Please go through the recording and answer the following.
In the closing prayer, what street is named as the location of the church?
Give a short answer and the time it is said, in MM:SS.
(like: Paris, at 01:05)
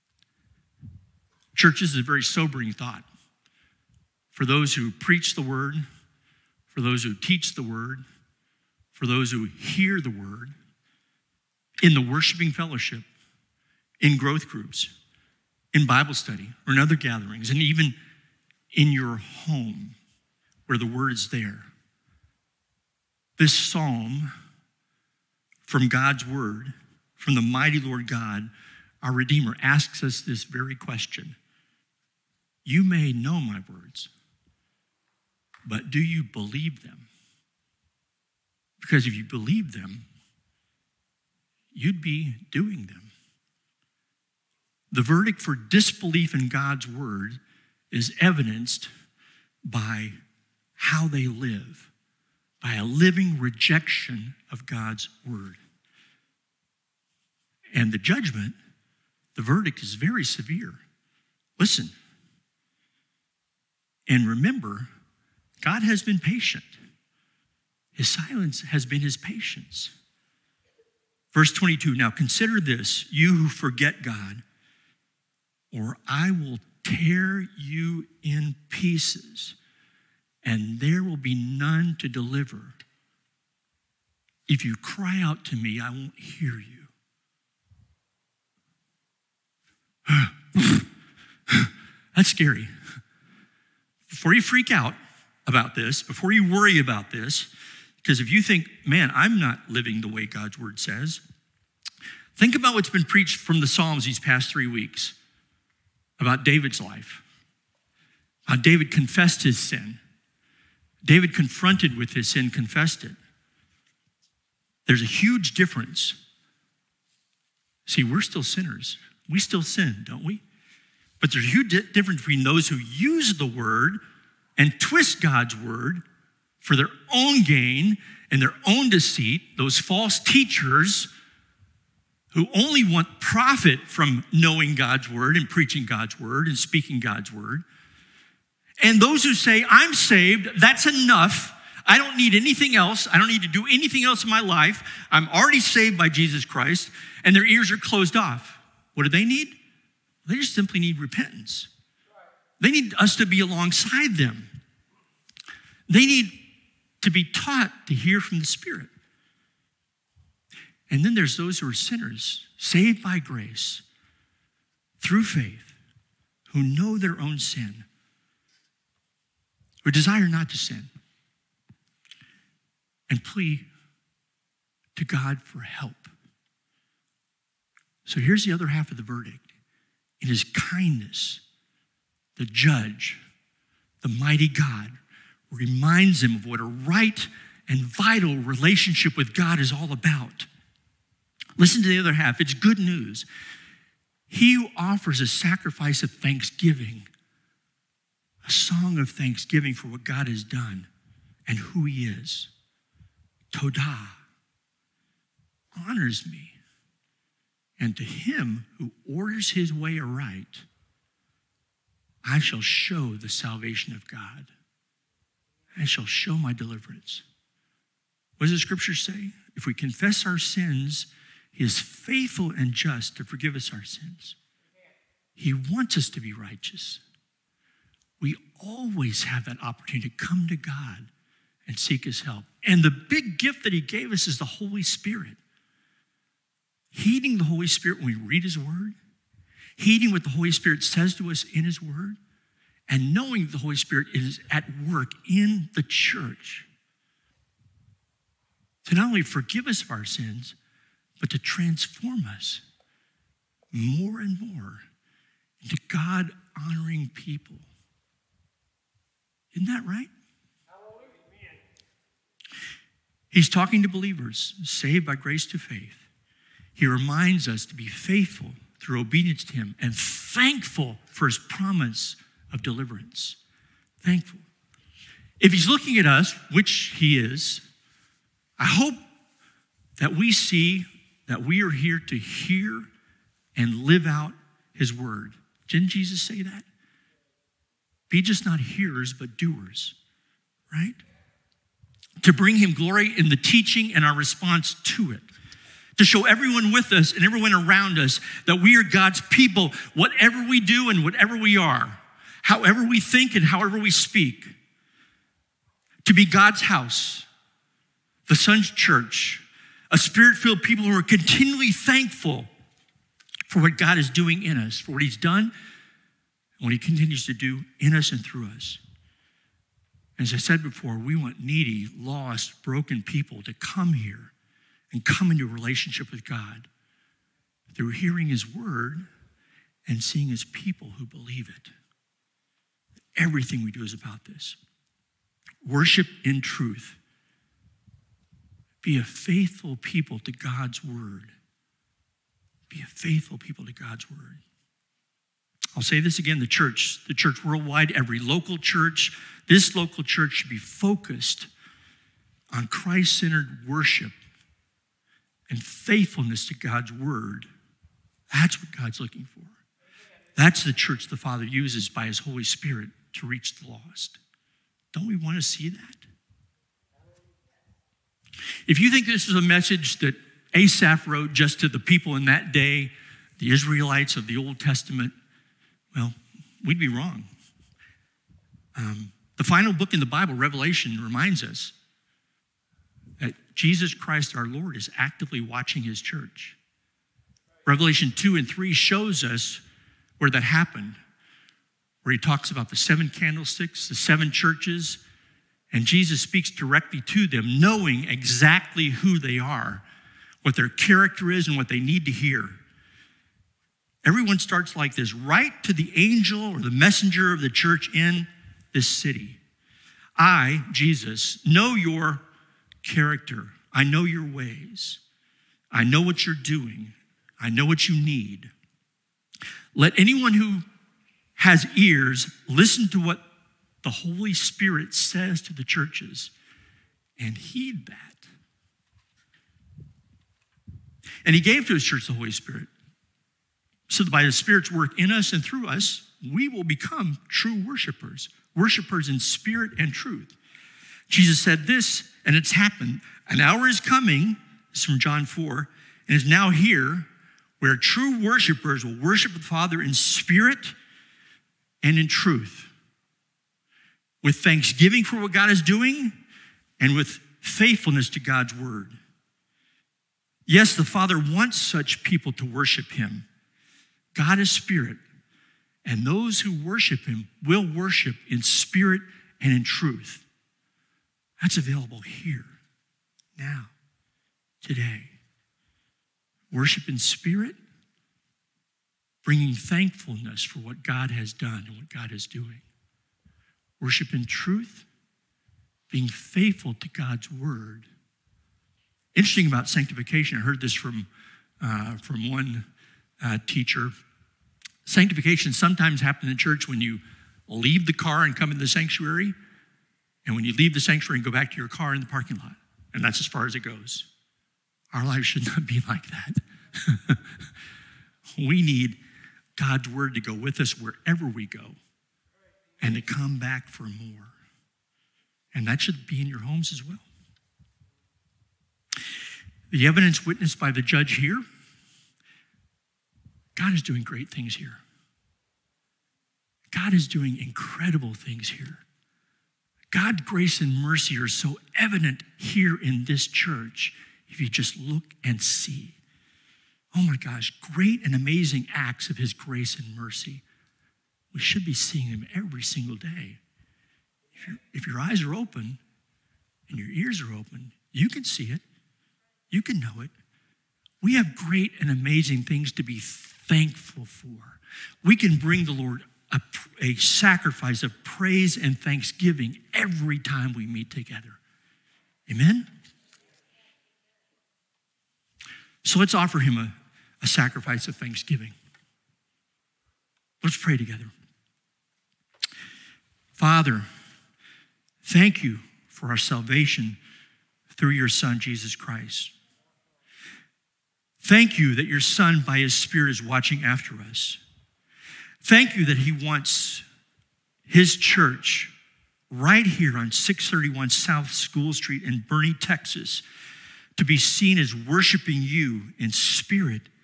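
South School Street, at 09:50.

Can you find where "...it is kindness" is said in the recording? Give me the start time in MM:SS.
03:00.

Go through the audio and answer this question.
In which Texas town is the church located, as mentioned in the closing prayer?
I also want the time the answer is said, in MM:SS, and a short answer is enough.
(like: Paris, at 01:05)
Boerne, at 09:52.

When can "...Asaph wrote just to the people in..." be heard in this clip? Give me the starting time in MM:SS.
06:10.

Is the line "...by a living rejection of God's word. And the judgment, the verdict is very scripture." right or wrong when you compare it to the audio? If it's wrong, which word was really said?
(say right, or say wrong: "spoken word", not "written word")
wrong: "severe", not "scripture".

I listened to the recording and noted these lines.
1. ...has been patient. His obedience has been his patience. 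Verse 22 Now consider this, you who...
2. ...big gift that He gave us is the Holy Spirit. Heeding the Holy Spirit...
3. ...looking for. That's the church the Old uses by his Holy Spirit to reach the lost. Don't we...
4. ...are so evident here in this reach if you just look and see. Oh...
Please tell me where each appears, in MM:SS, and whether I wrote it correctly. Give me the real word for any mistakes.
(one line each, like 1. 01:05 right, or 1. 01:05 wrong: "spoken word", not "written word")
1. 01:05 wrong: "silence", not "obedience"
2. 03:52 right
3. 05:59 wrong: "Father", not "Old"
4. 08:51 wrong: "church", not "reach".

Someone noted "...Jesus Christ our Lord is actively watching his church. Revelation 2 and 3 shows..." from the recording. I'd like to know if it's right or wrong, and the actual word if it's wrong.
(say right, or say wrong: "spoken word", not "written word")
right.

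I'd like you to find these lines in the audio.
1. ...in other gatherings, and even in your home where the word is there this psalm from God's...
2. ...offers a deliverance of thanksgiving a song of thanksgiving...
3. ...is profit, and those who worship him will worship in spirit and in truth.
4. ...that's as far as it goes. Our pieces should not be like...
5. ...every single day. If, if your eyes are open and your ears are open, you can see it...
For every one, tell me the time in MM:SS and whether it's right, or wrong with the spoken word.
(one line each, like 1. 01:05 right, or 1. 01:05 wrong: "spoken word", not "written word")
1. 00:16 right
2. 03:14 wrong: "sacrifice", not "deliverance"
3. 07:44 wrong: "spirit", not "profit"
4. 08:23 wrong: "lives", not "pieces"
5. 09:02 right.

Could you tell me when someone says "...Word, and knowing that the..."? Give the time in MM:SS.
04:01.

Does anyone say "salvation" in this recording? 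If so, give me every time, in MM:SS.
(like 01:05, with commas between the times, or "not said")
03:33, 09:36.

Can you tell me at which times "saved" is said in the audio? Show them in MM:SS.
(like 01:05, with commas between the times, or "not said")
02:19, 02:25, 02:42, 04:24.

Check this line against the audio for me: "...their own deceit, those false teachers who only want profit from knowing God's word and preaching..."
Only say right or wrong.
right.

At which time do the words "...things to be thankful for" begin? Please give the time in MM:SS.
09:12.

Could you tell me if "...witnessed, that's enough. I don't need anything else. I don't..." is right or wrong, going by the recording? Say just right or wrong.
wrong.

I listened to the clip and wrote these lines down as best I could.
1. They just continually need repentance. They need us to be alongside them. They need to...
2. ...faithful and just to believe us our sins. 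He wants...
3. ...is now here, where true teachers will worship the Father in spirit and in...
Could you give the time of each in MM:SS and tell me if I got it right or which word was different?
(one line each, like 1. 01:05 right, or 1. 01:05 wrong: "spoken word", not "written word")
1. 02:30 wrong: "simply", not "continually"
2. 03:41 wrong: "forgive", not "believe"
3. 07:26 wrong: "worshipers", not "teachers".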